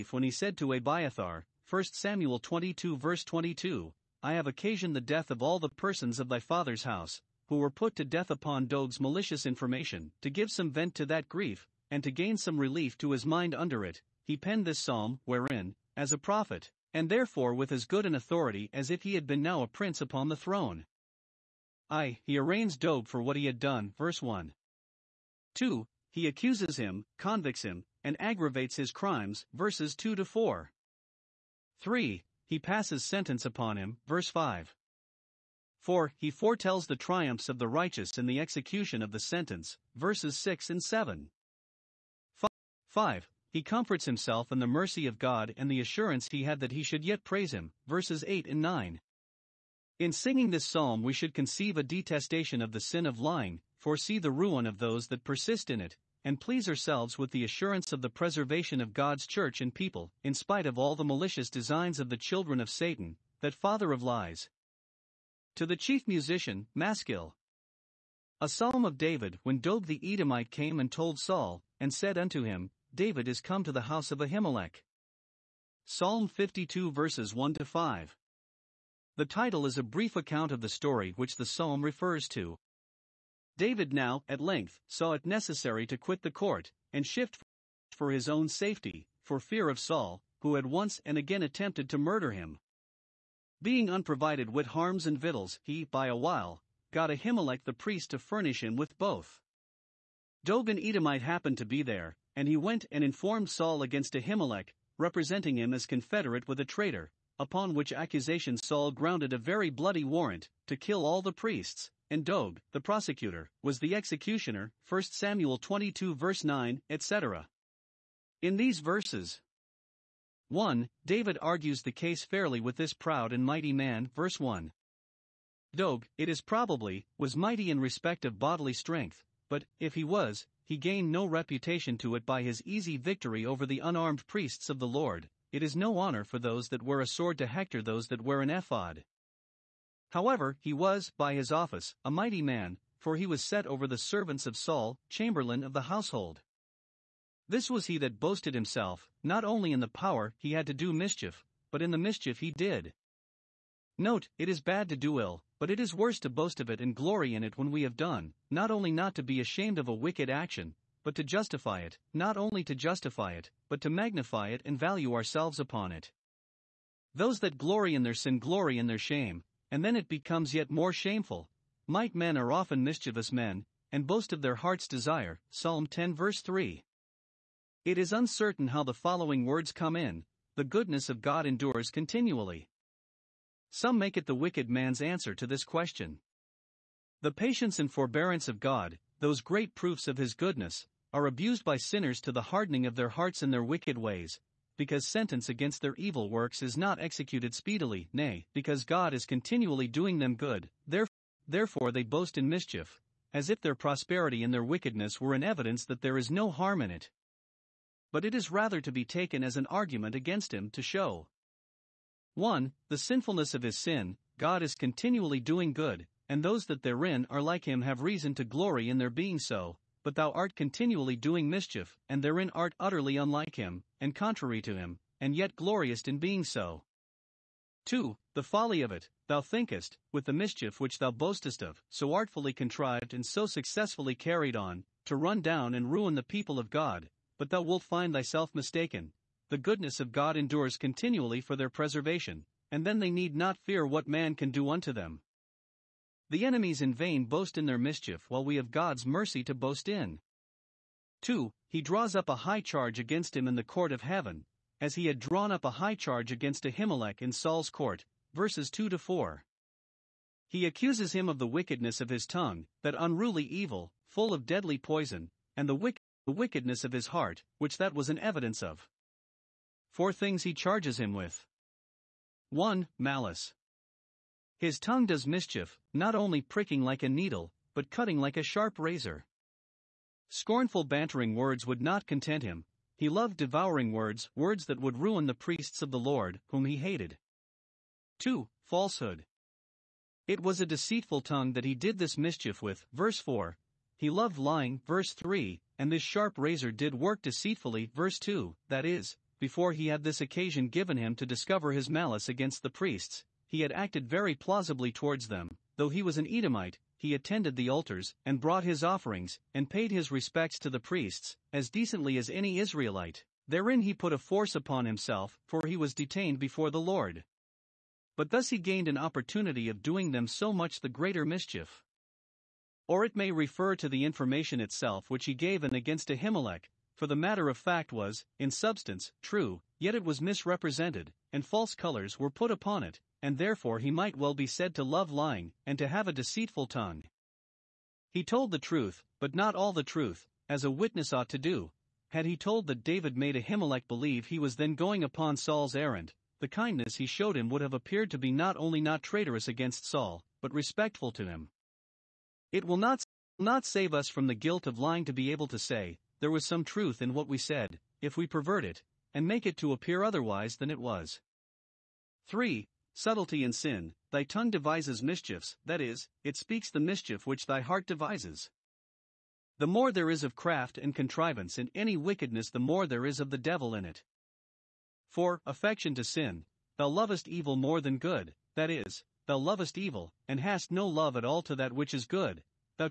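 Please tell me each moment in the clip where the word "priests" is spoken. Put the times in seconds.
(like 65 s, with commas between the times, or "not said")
97 s, 111 s, 134 s, 285 s, 302 s, 310 s.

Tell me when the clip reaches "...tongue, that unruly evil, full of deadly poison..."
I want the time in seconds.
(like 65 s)
262 s.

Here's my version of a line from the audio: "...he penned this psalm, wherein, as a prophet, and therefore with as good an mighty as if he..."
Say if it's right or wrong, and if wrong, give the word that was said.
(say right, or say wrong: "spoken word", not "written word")
wrong: "authority", not "mighty".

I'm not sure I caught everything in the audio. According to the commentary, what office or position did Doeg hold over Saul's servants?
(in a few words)
Chamberlain of the household.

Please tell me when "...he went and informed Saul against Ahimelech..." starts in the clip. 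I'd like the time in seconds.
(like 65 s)
102 s.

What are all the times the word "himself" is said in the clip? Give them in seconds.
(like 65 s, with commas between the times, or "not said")
44 s, 148 s, 314 s.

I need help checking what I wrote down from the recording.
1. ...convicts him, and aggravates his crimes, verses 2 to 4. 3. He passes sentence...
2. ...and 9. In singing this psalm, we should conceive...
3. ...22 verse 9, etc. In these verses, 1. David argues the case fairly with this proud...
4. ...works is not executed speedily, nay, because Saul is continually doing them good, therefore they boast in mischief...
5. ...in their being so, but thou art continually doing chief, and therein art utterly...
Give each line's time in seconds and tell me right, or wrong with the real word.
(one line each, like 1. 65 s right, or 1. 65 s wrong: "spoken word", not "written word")
1. 27 s right
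2. 48 s right
3. 115 s right
4. 196 s wrong: "God", not "Saul"
5. 218 s wrong: "mischief", not "chief".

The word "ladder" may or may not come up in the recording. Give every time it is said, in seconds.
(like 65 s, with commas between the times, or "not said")
not said.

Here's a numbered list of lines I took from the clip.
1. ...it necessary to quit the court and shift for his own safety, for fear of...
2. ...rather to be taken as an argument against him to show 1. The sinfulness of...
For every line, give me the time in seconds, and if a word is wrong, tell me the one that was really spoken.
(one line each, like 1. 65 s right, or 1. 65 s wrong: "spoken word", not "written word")
1. 85 s right
2. 208 s right.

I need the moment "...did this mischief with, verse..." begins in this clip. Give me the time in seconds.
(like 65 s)
291 s.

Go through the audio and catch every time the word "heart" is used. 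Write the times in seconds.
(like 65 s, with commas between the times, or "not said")
174 s, 193 s, 267 s, 367 s.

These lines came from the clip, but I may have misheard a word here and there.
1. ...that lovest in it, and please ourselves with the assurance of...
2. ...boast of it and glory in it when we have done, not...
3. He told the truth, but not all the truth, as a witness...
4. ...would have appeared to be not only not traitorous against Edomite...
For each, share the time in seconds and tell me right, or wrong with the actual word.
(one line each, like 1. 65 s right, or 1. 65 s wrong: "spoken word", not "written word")
1. 55 s wrong: "persist", not "lovest"
2. 156 s right
3. 338 s right
4. 347 s wrong: "Saul", not "Edomite".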